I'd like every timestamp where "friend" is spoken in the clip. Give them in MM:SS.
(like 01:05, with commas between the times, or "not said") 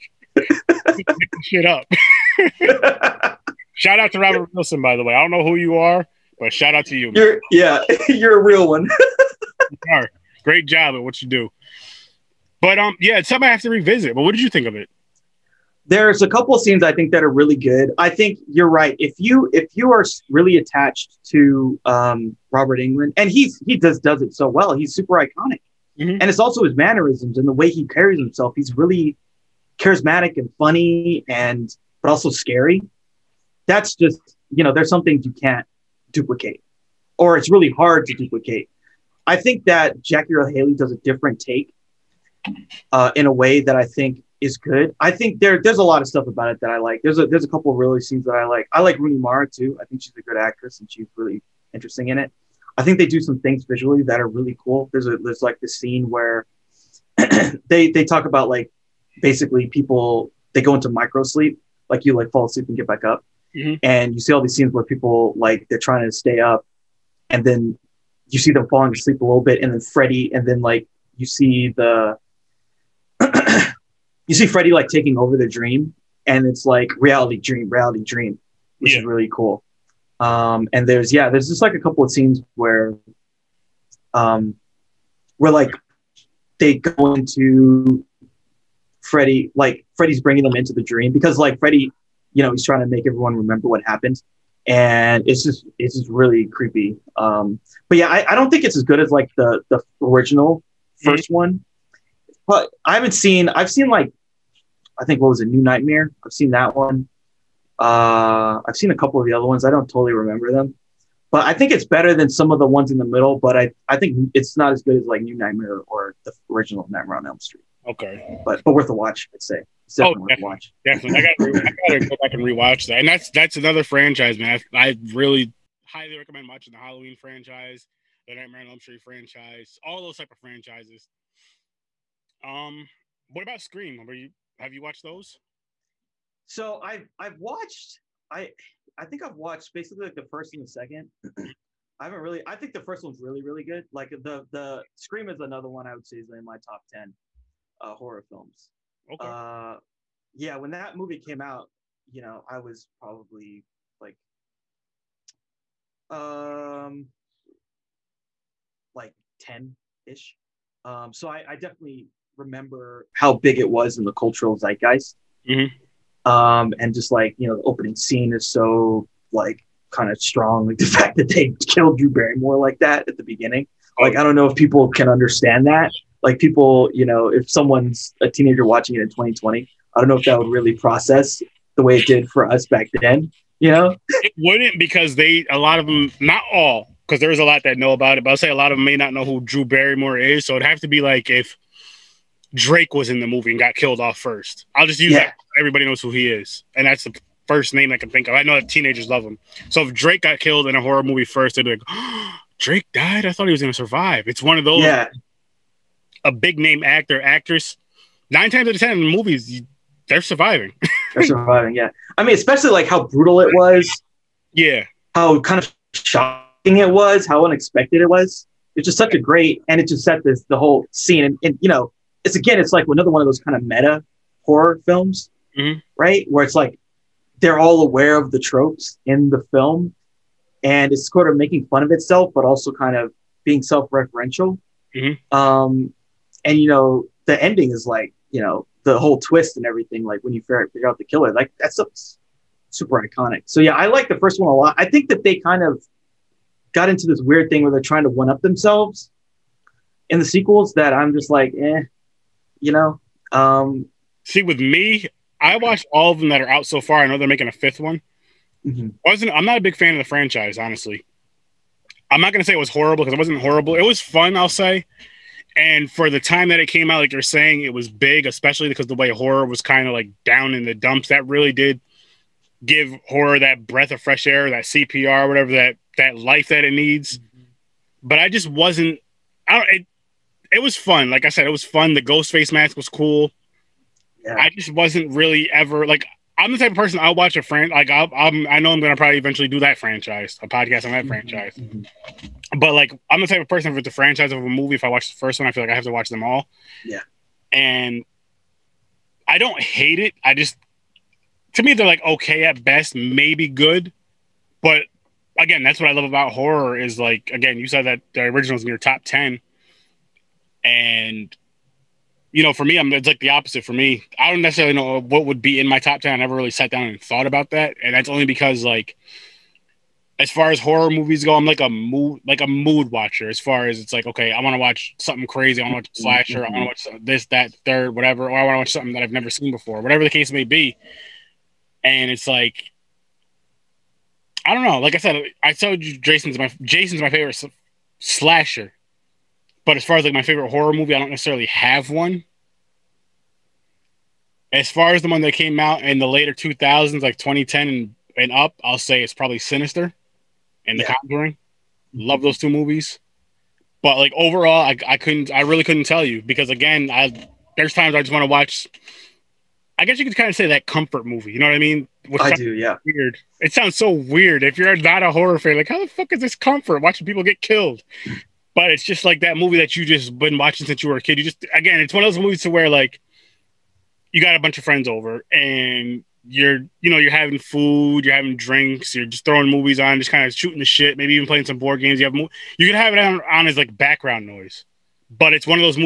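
04:47, 06:14.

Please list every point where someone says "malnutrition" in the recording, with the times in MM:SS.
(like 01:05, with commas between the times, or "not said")
not said.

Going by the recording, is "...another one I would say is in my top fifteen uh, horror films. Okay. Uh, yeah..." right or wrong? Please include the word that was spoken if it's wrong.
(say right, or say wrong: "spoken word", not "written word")
wrong: "ten", not "fifteen".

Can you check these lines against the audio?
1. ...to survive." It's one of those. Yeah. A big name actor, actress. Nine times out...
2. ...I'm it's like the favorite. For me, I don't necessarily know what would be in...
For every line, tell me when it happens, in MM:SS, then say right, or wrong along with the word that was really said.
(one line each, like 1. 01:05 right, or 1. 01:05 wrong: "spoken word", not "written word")
1. 03:23 right
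2. 05:12 wrong: "opposite", not "favorite".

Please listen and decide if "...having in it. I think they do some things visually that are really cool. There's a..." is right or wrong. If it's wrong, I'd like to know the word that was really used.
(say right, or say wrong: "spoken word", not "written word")
wrong: "interesting", not "having".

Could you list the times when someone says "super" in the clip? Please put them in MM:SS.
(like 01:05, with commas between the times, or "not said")
00:24, 04:02.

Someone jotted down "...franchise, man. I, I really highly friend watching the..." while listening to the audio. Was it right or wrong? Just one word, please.
wrong.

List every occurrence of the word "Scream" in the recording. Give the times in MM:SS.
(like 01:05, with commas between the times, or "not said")
02:13, 02:24.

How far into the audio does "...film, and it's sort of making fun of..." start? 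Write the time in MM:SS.
03:49.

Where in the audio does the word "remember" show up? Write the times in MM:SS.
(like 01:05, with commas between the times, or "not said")
01:33, 01:50, 02:42.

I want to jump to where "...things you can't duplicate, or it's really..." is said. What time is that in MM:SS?
00:35.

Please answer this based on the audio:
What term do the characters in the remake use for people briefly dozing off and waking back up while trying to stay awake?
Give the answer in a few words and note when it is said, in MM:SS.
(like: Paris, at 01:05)
micro sleep, at 01:00.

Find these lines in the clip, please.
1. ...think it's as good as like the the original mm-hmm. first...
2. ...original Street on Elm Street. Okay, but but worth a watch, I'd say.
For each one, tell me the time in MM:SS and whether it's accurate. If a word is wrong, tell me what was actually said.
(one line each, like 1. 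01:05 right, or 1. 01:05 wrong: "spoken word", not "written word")
1. 01:38 right
2. 01:56 wrong: "Nightmare", not "Street".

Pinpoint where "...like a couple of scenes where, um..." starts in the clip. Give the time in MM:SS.
01:21.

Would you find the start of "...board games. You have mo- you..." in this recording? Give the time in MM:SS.
06:21.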